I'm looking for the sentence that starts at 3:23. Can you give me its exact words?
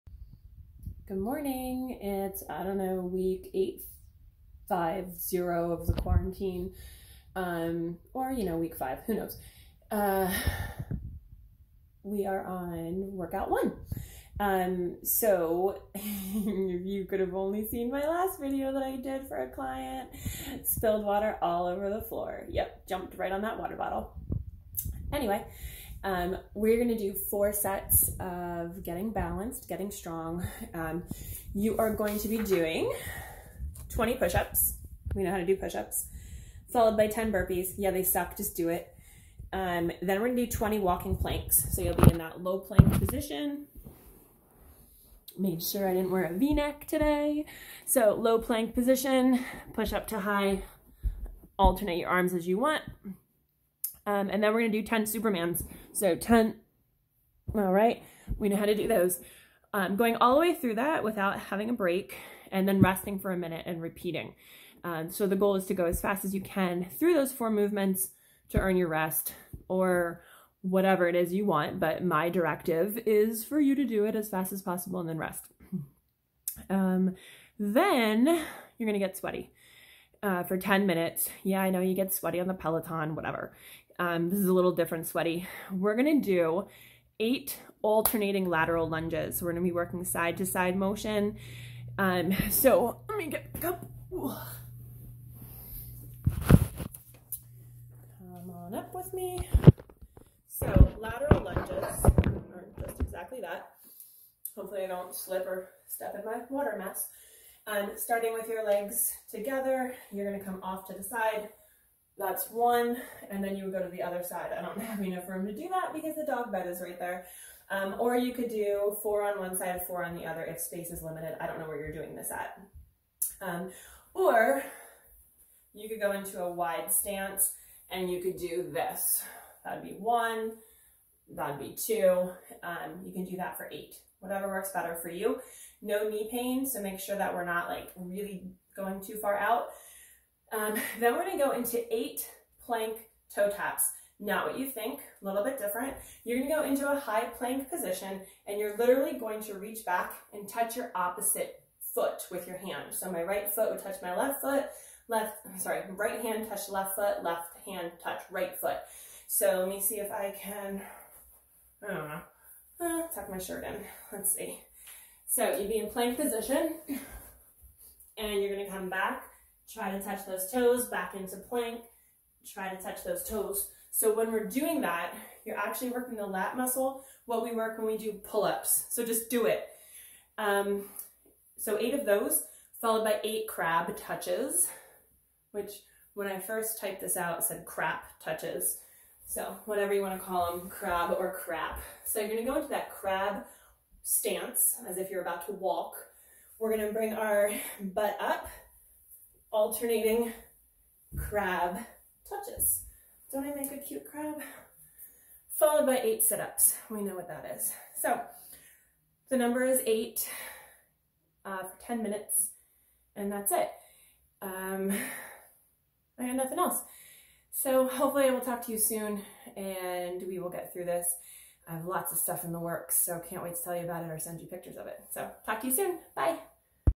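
Don't I make a cute crab?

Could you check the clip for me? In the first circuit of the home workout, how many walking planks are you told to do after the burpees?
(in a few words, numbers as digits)
20.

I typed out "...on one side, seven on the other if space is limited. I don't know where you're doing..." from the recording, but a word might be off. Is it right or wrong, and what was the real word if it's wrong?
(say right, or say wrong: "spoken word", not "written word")
wrong: "four", not "seven".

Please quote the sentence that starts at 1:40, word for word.
So lateral lunges are just exactly that.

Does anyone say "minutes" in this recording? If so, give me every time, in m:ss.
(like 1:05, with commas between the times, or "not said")
1:03, 1:20, 3:32.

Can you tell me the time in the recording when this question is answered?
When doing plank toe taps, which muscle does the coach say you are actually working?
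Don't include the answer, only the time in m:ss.
2:56.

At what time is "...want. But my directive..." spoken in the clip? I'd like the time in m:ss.
1:11.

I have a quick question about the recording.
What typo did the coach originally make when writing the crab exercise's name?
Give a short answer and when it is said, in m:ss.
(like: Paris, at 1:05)
crap touches, at 3:07.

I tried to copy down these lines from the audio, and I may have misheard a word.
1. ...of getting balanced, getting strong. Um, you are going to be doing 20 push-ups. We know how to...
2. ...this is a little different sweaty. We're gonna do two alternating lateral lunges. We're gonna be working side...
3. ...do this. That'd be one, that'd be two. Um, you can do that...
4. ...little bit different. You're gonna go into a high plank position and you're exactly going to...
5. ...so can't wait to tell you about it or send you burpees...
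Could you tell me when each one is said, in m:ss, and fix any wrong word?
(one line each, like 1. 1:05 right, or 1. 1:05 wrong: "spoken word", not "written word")
1. 0:28 right
2. 1:24 wrong: "eight", not "two"
3. 2:08 right
4. 2:25 wrong: "literally", not "exactly"
5. 3:43 wrong: "pictures", not "burpees".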